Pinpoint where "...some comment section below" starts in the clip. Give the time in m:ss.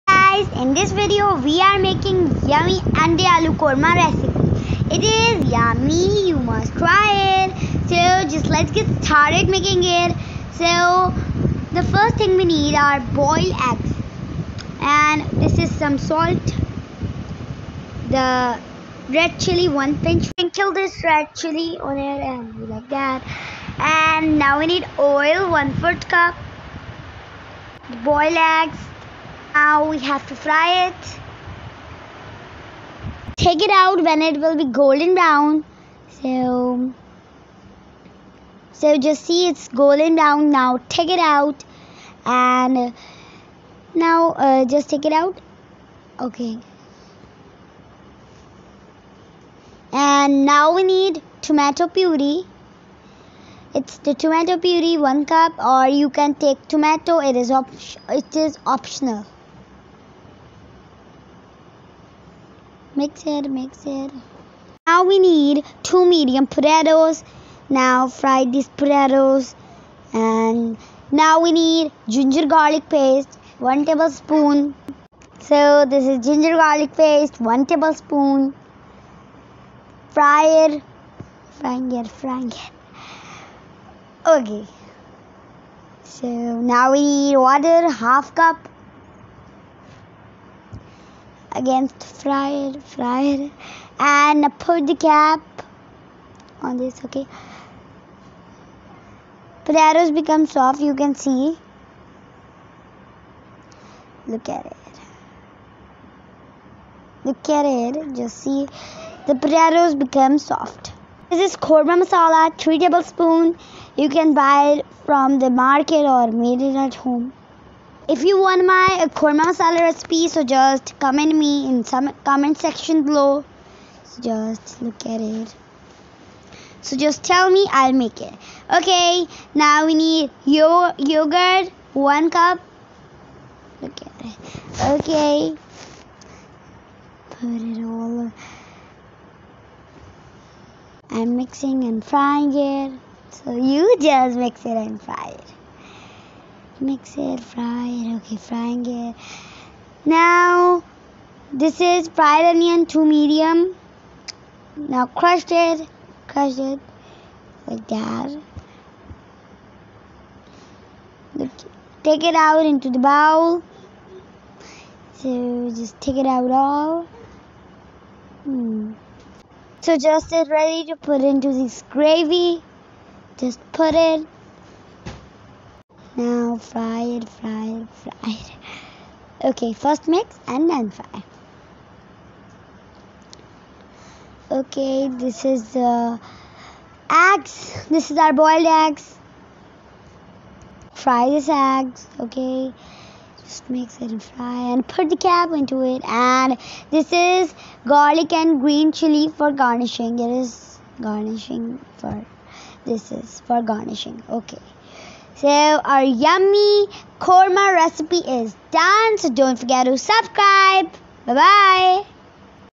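2:01.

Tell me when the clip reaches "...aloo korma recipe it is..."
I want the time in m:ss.
0:03.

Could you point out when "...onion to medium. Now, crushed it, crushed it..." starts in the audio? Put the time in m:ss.
2:32.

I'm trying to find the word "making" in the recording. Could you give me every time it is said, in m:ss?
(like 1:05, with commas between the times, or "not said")
0:01, 0:09.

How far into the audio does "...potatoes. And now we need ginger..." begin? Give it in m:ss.
1:08.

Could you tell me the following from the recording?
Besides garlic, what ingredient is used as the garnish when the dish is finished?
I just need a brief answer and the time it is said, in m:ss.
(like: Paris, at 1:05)
green chili, at 3:18.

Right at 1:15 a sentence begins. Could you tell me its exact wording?
So this is ginger garlic paste, one tablespoon.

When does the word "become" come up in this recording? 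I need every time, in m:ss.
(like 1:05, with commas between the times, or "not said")
1:40, 1:50.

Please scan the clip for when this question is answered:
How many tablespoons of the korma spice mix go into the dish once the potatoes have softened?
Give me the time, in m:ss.
1:52.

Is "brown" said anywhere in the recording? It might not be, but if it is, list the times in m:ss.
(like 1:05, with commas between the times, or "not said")
0:35, 0:40.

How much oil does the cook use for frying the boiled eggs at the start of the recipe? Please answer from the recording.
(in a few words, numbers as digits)
1/4 cup.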